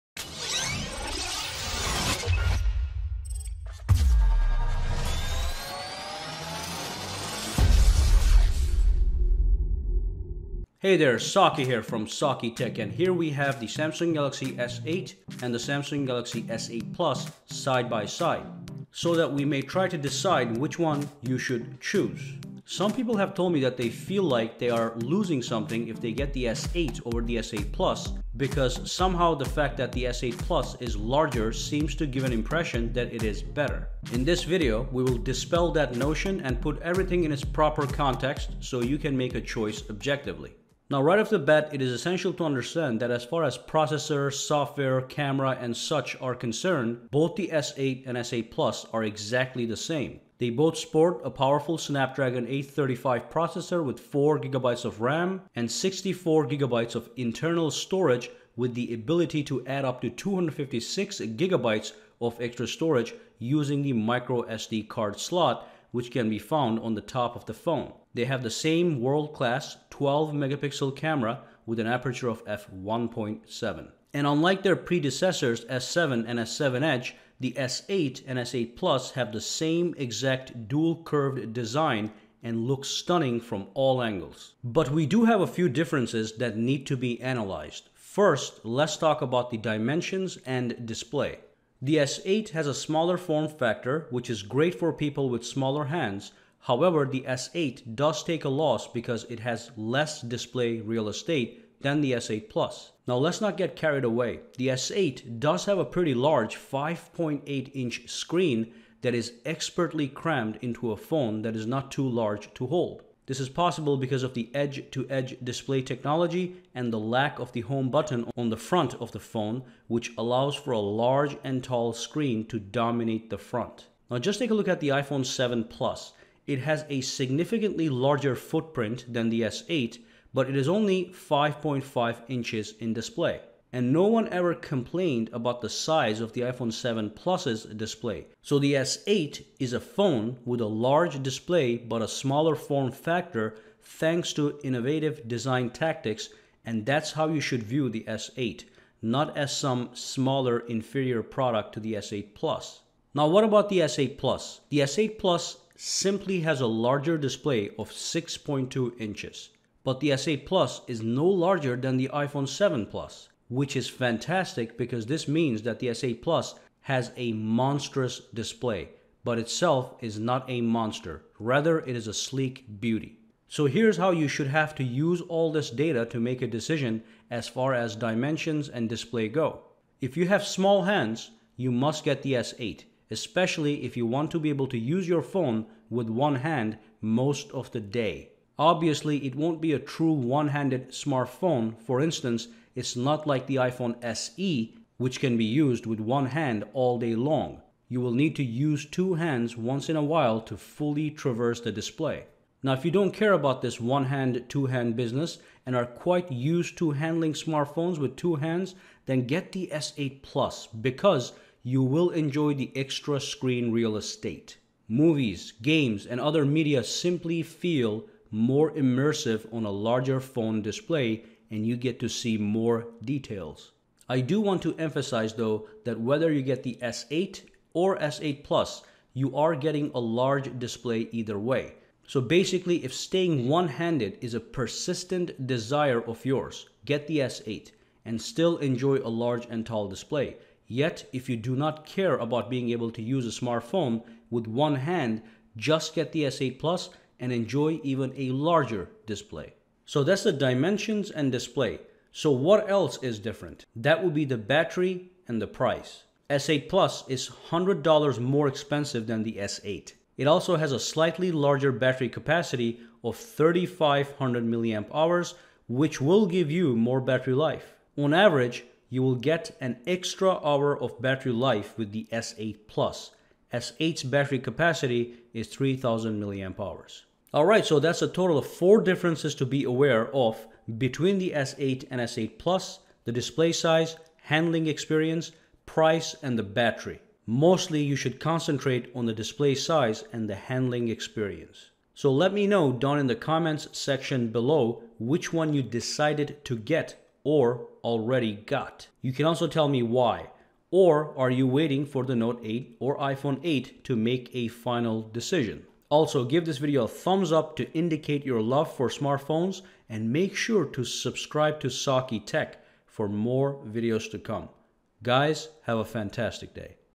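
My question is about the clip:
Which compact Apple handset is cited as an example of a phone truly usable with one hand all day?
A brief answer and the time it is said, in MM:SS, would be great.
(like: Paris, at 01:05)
iPhone SE, at 03:13.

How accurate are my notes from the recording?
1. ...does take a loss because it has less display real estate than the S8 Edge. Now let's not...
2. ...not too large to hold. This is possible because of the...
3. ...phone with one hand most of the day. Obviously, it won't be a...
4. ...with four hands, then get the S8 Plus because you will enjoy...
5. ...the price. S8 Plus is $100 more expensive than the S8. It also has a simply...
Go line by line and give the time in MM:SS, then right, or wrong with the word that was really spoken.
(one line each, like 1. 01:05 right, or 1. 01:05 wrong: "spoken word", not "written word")
1. 01:37 wrong: "Plus", not "Edge"
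2. 01:51 right
3. 03:05 right
4. 03:27 wrong: "two", not "four"
5. 04:15 wrong: "slightly", not "simply".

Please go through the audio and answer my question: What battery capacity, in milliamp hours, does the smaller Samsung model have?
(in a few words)
3000 mAh.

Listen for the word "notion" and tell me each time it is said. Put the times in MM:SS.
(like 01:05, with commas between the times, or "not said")
00:35.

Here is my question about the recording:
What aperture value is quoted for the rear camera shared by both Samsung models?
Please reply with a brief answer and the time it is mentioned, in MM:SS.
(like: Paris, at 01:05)
f1.7, at 01:12.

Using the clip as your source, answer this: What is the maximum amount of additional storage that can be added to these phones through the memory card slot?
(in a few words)
256GB.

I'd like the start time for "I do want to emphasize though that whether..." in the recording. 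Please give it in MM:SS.
03:44.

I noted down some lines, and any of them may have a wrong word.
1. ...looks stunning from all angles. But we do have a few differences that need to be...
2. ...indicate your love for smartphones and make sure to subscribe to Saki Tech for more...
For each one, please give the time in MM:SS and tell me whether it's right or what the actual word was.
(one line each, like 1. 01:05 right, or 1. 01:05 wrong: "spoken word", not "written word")
1. 01:22 right
2. 05:07 right.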